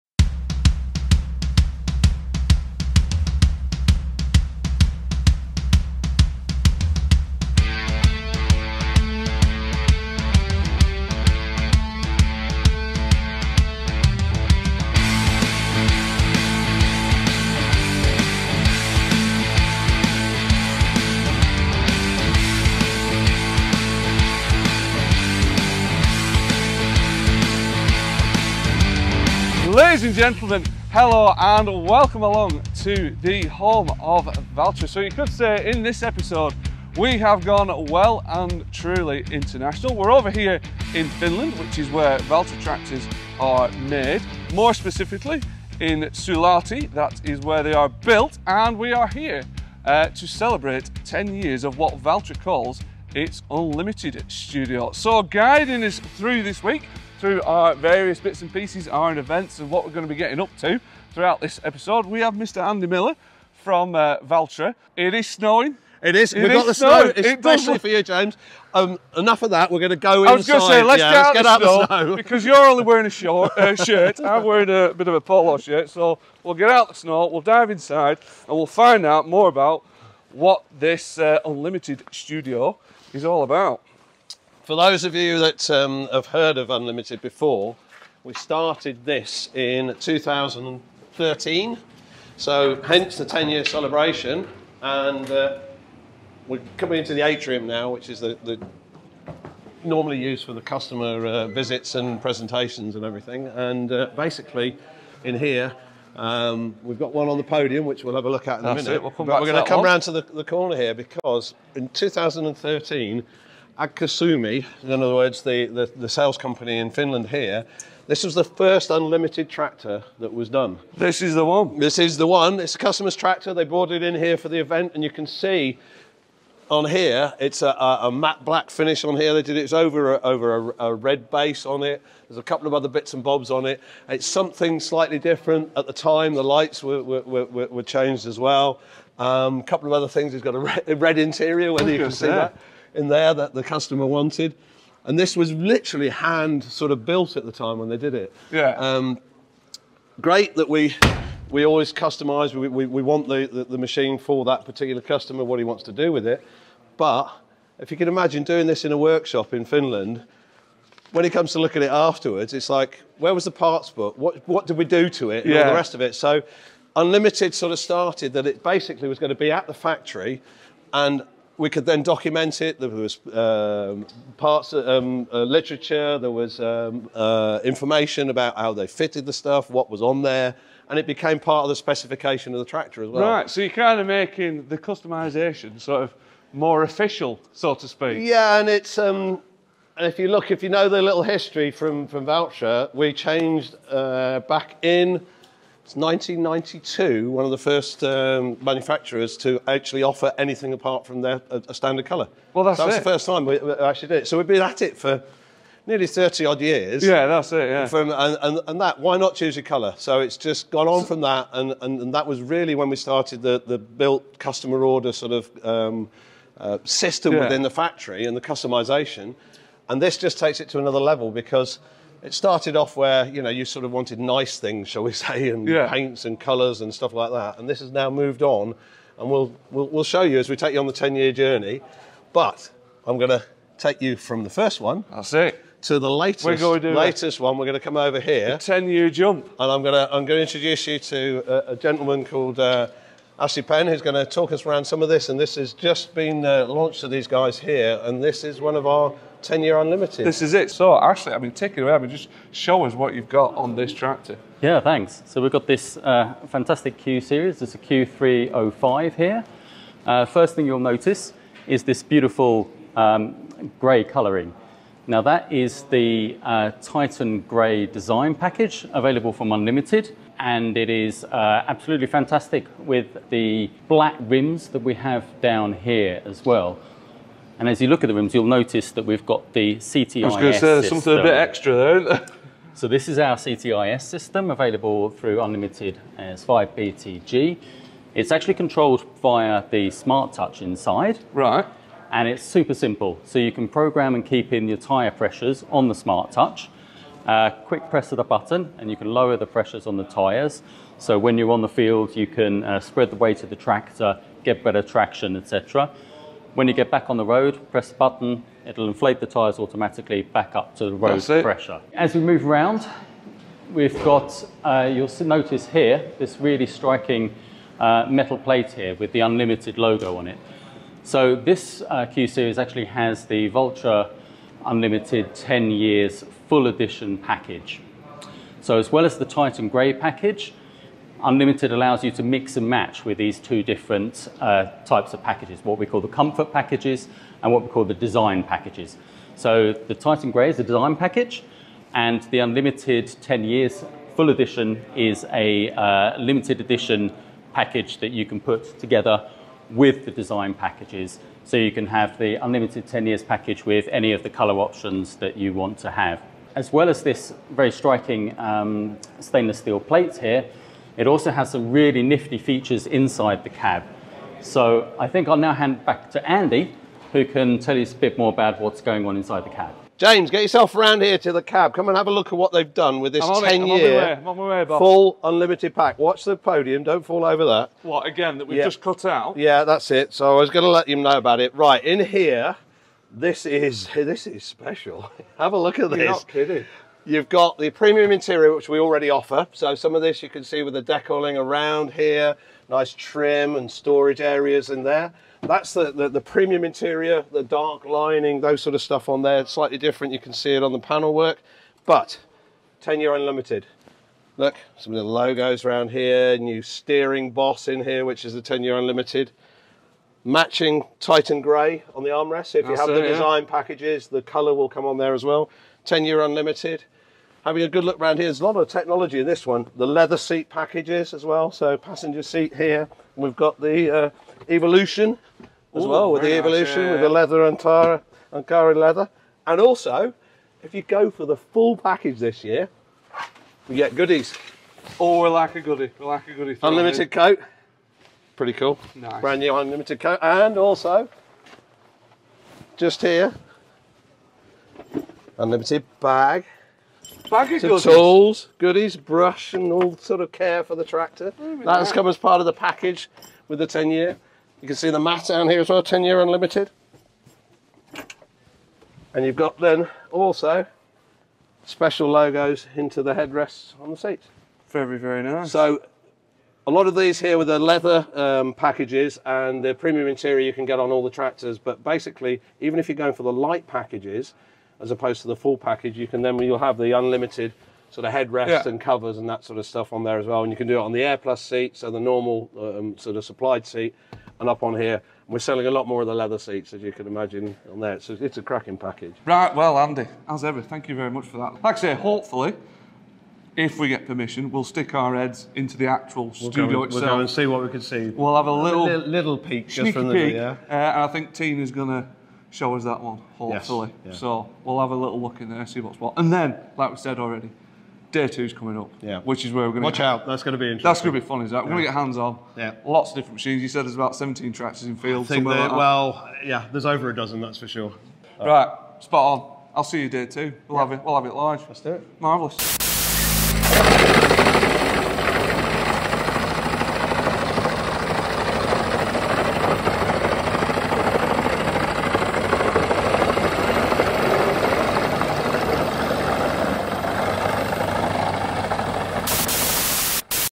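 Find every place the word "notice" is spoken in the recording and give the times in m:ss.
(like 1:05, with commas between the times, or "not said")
4:20, 4:38, 5:15.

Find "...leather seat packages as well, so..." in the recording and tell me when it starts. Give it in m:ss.
6:59.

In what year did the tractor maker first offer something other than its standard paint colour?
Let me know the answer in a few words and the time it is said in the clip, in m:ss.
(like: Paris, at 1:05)
1992, at 3:15.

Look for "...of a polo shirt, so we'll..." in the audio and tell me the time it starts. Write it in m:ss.
1:15.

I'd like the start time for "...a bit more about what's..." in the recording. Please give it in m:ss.
6:07.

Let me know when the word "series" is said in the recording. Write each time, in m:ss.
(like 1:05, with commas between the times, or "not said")
4:17, 5:22.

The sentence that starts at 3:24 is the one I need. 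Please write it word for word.
So we've been at it for nearly 30 odd years.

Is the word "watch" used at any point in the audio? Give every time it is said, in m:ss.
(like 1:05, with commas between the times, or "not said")
6:15, 8:29.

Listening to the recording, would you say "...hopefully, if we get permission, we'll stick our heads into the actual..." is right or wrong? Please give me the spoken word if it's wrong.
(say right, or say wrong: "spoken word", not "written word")
right.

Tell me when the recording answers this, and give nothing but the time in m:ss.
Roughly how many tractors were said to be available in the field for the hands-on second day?
8:34.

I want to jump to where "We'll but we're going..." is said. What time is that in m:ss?
1:49.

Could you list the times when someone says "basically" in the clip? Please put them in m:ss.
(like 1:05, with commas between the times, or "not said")
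1:44, 2:48, 7:51.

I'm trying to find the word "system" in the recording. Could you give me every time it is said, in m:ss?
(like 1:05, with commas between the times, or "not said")
3:36, 4:44.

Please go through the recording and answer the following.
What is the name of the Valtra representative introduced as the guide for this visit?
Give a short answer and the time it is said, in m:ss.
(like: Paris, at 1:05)
Andy Miller, at 1:02.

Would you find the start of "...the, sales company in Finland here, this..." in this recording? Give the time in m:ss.
1:55.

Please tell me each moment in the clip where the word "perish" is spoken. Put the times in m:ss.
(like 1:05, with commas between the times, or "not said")
not said.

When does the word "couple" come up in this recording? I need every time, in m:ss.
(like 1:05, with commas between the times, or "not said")
2:12, 2:19.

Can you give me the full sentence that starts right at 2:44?
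What, what did we do to it and yeah.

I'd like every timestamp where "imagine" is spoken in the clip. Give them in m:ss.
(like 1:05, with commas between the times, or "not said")
2:38, 8:07.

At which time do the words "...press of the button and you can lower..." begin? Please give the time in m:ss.
4:57.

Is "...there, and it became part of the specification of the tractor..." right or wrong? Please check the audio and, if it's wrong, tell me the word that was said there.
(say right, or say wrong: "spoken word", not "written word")
right.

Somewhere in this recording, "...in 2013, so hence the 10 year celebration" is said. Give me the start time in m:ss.
1:29.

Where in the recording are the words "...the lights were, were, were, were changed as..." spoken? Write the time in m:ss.
2:16.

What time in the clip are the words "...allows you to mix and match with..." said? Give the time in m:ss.
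5:31.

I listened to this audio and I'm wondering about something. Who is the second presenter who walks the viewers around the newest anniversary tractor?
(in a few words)
Ashley Penn.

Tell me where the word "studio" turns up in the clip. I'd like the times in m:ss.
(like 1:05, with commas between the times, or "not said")
0:54, 1:22, 8:16.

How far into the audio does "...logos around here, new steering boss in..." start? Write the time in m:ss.
6:45.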